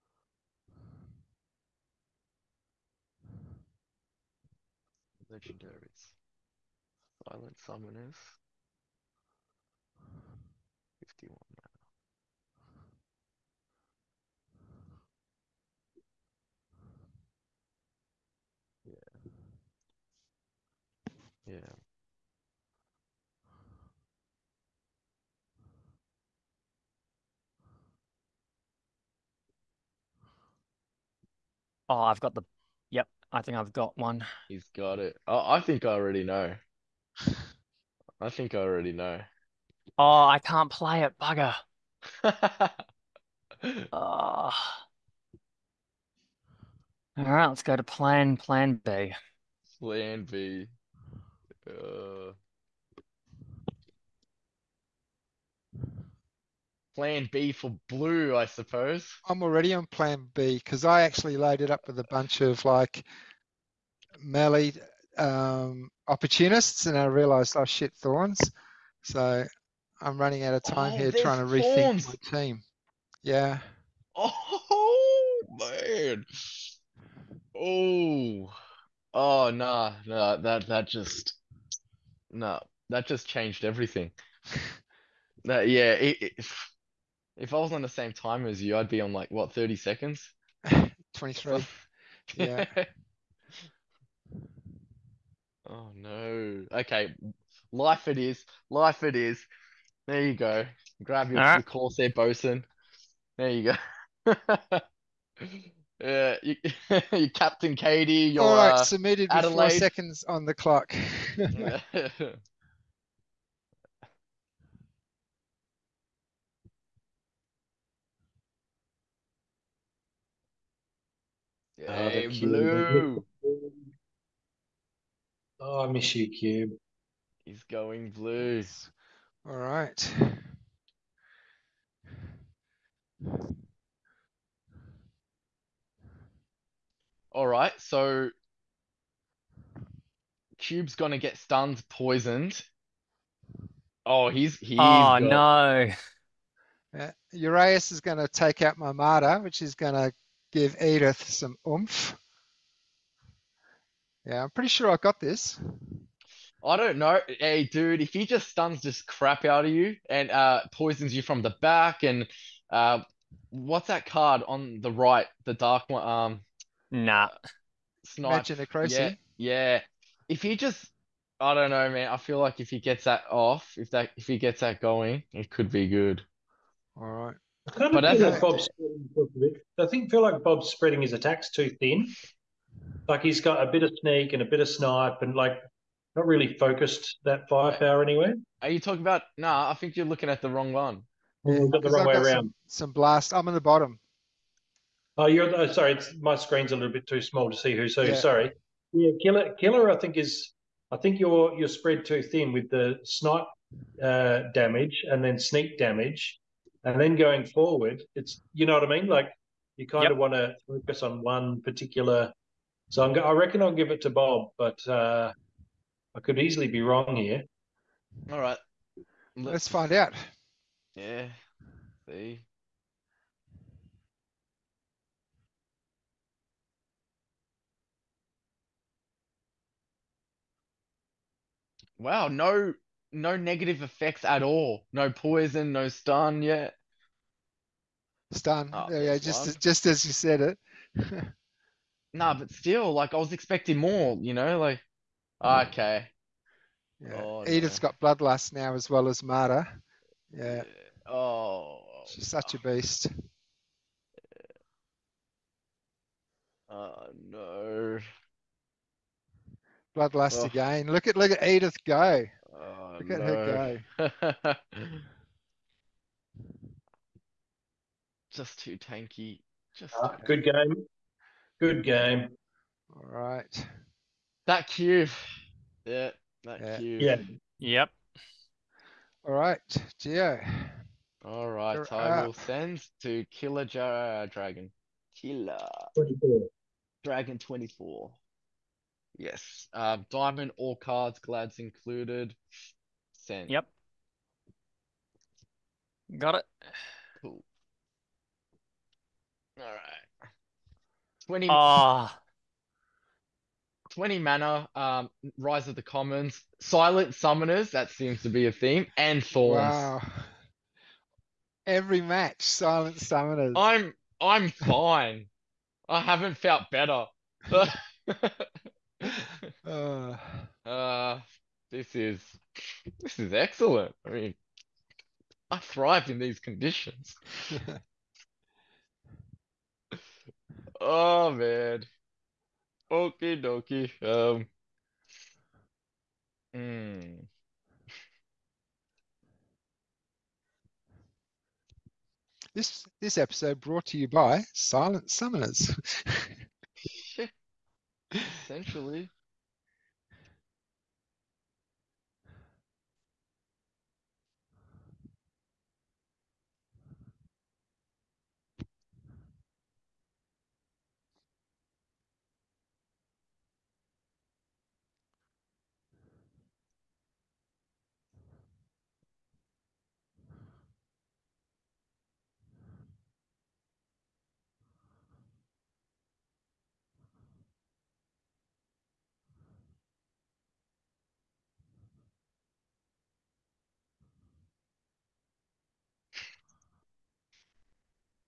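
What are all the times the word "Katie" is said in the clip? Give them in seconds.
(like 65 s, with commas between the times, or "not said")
107 s.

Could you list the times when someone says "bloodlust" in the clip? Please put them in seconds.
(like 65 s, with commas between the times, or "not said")
248 s, 259 s.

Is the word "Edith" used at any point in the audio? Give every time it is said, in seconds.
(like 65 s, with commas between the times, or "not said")
150 s, 247 s, 261 s.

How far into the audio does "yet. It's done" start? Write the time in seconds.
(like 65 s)
236 s.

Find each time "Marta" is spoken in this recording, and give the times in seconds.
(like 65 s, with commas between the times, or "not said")
148 s, 249 s.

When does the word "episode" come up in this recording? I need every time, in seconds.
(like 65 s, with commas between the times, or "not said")
343 s.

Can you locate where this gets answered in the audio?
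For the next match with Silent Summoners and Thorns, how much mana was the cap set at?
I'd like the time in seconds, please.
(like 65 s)
303 s.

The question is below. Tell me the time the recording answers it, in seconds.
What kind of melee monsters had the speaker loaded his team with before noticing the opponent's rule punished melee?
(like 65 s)
66 s.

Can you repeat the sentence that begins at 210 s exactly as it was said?
of want to focus on one particular.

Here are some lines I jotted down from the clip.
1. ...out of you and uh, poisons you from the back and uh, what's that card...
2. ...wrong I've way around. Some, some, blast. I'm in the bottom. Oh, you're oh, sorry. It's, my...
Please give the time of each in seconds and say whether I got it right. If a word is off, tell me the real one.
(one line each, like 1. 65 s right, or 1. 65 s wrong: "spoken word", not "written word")
1. 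159 s right
2. 191 s right.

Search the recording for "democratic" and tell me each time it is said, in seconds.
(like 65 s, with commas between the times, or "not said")
not said.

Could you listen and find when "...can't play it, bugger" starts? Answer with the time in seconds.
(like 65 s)
40 s.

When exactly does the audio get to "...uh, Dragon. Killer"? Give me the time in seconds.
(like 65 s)
283 s.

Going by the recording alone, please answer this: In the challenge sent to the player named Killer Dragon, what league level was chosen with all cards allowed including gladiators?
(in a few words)
diamond.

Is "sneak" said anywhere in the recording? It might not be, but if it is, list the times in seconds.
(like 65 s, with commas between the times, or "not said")
184 s, 205 s.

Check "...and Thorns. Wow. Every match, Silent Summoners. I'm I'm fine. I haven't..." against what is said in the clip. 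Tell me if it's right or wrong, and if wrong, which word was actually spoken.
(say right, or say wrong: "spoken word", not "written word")
right.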